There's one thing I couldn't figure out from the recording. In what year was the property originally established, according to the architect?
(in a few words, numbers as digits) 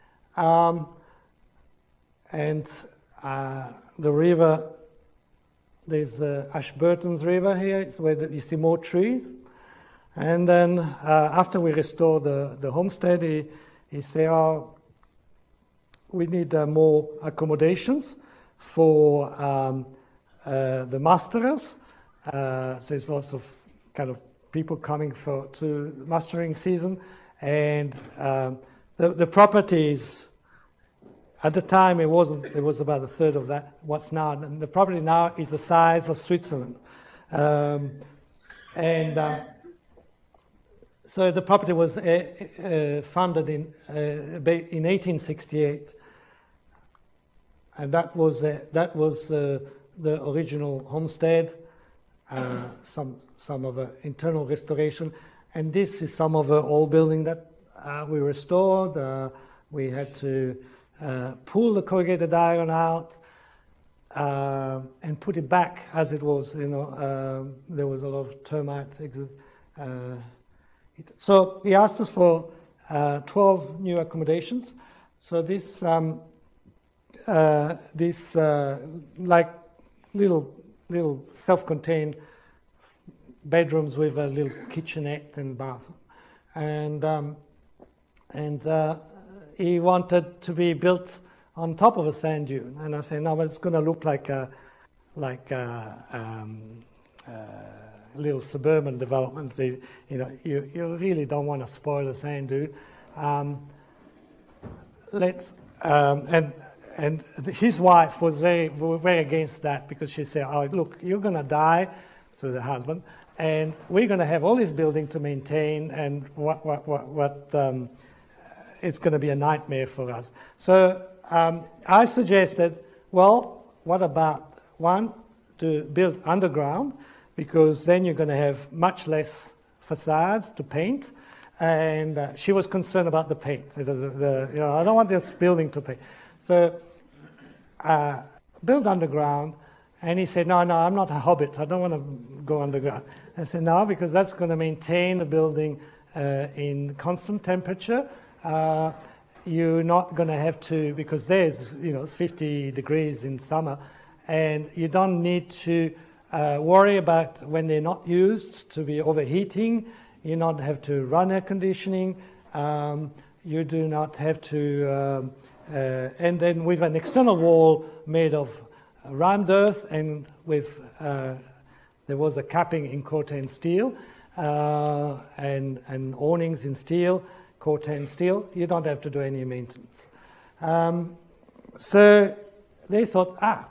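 1868.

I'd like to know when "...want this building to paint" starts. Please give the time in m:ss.
2:14.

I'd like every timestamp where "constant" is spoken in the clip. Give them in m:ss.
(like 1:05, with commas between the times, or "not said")
2:26.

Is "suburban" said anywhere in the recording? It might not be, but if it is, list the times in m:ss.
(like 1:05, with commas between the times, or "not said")
1:38.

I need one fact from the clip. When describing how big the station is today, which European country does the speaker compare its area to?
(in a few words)
Switzerland.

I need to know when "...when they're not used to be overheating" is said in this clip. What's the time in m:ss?
2:37.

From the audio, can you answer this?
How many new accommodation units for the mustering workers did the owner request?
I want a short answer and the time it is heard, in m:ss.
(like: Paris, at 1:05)
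12, at 1:13.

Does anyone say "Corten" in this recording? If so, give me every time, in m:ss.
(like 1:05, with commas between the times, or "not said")
2:53, 2:57.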